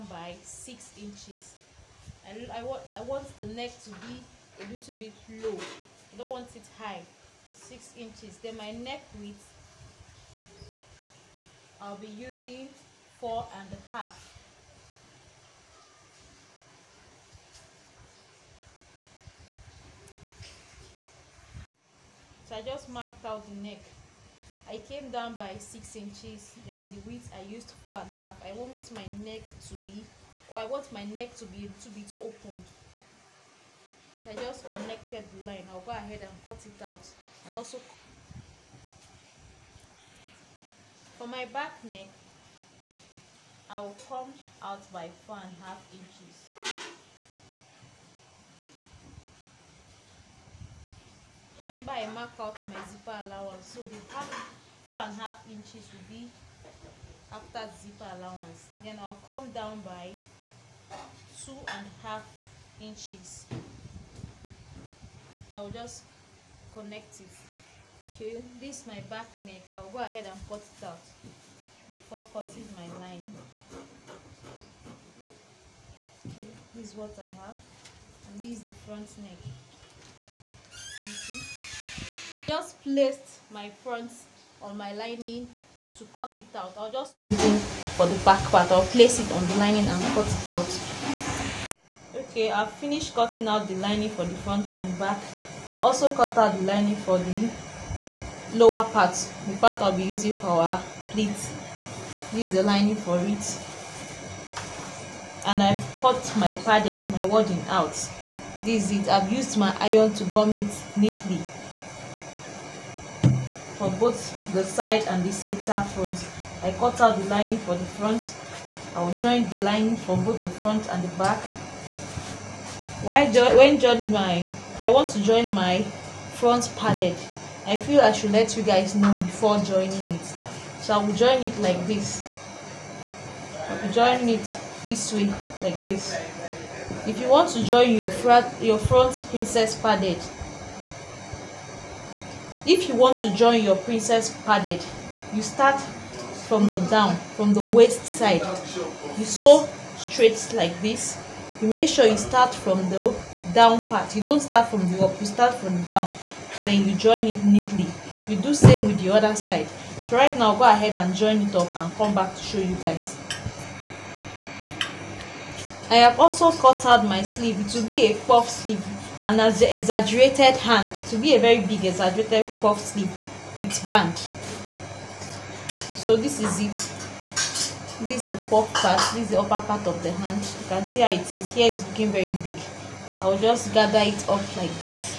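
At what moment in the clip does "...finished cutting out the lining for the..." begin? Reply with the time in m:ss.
1:32.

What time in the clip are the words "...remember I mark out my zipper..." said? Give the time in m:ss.
0:51.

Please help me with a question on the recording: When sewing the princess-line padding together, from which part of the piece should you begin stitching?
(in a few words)
the waist side.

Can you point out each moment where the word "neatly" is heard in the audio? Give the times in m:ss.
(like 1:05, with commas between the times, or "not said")
1:50, 2:37.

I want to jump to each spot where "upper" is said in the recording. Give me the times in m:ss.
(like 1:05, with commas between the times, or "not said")
2:59.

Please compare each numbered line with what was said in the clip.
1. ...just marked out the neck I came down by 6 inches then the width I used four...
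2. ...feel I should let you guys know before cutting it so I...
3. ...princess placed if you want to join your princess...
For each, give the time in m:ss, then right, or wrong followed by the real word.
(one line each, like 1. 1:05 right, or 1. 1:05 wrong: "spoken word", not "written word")
1. 0:22 right
2. 2:07 wrong: "joining", not "cutting"
3. 2:19 wrong: "padded", not "placed".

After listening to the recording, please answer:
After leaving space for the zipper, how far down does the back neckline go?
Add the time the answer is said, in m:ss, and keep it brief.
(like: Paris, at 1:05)
2.5 inches, at 1:01.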